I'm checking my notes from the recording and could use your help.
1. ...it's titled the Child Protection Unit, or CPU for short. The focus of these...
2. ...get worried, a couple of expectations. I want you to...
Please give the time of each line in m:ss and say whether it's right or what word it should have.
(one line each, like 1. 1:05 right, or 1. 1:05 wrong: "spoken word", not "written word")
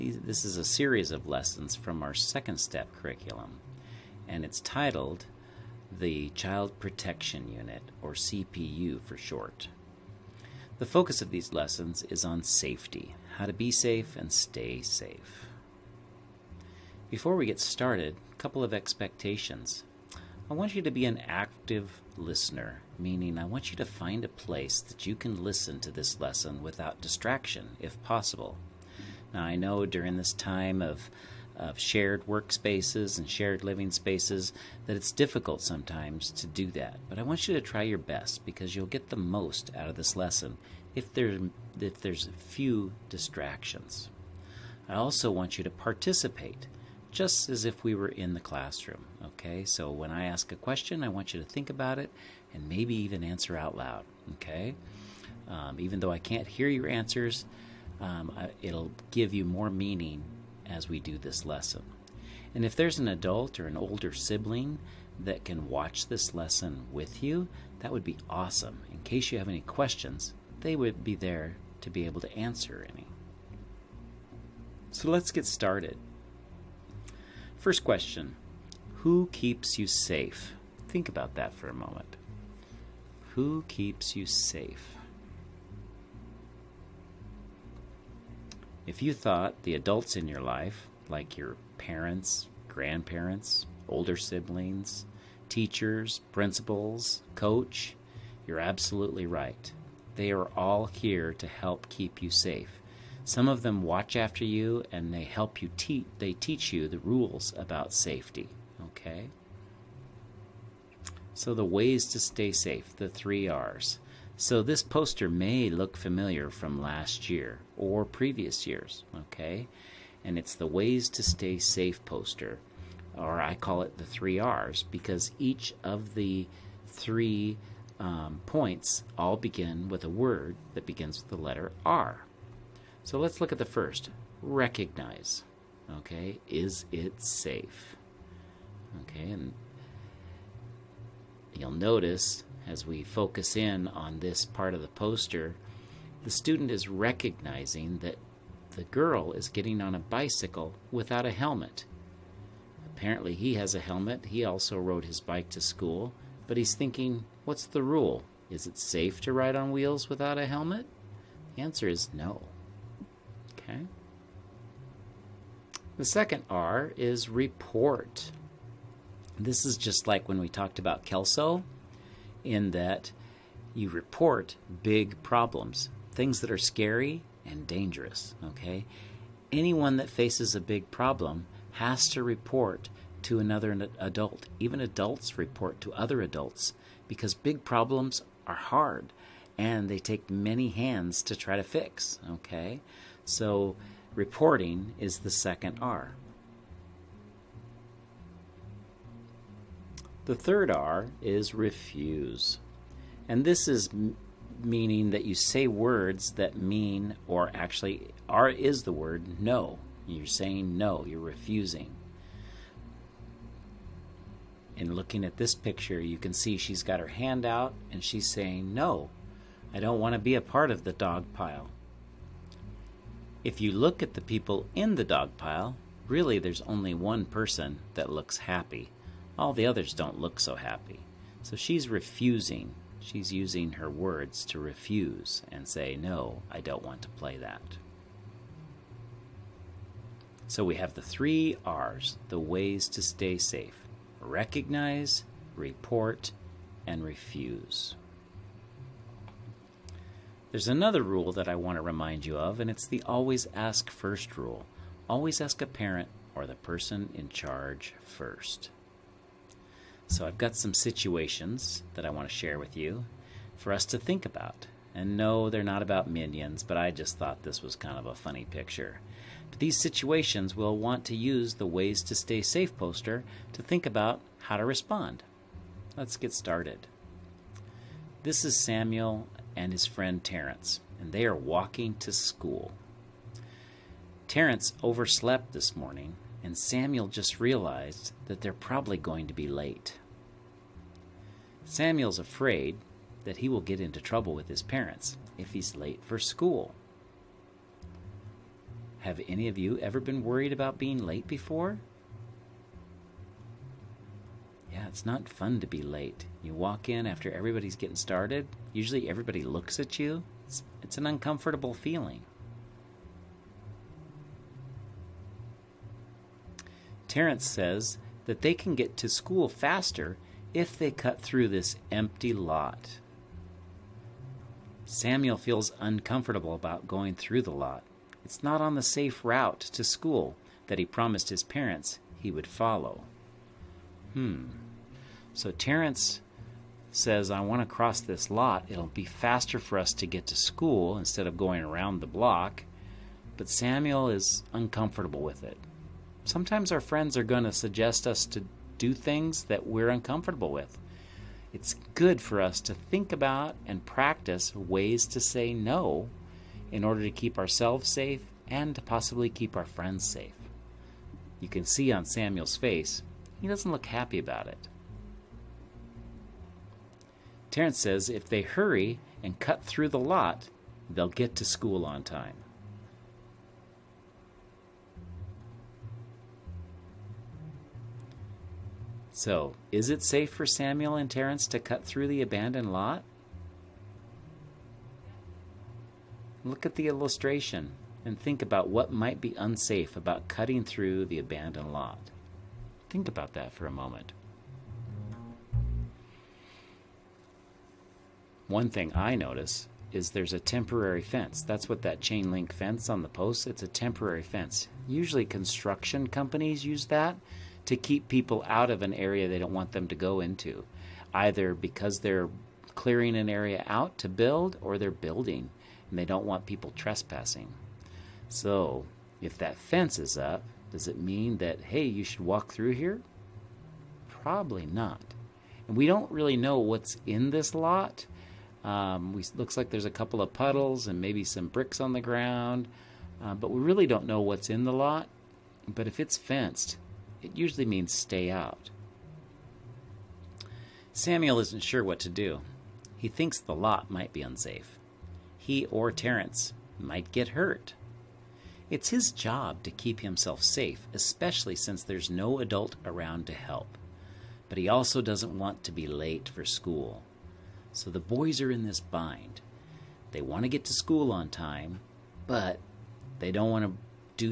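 1. 0:04 right
2. 0:17 wrong: "started", not "worried".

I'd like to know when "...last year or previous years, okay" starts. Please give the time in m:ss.
1:56.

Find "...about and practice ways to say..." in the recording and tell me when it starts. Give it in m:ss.
5:53.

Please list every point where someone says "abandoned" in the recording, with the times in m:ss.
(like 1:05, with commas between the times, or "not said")
6:22, 6:31.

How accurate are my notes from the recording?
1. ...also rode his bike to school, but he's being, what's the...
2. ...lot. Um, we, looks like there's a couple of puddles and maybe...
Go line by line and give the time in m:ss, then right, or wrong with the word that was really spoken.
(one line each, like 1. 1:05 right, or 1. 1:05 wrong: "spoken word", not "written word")
1. 2:34 wrong: "thinking", not "being"
2. 7:07 right.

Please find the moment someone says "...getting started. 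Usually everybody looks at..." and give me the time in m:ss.
5:07.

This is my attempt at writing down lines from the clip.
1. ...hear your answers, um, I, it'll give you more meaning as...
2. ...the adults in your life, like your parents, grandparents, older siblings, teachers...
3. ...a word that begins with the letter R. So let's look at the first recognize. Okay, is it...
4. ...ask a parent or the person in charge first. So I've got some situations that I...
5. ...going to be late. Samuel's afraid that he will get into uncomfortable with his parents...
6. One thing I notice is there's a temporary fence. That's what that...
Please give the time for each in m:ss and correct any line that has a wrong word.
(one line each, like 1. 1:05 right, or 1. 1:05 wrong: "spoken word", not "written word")
1. 0:56 right
2. 1:29 right
3. 2:10 right
4. 4:15 right
5. 4:48 wrong: "trouble", not "uncomfortable"
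6. 6:38 right.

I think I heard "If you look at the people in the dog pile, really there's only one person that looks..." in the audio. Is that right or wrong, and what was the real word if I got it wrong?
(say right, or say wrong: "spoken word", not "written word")
right.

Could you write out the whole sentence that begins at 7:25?
He or Terence might get hurt.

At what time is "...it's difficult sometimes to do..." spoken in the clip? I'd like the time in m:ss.
0:34.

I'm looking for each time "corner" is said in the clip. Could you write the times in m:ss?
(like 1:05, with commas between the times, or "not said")
not said.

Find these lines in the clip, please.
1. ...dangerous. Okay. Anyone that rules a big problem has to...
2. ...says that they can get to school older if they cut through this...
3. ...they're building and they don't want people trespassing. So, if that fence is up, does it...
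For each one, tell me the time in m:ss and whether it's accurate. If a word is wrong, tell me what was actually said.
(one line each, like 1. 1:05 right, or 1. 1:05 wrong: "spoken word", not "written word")
1. 2:57 wrong: "faces", not "rules"
2. 5:17 wrong: "faster", not "older"
3. 6:54 right.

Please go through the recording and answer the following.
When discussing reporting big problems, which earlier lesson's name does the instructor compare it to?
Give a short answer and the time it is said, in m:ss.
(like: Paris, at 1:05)
Kelso, at 2:51.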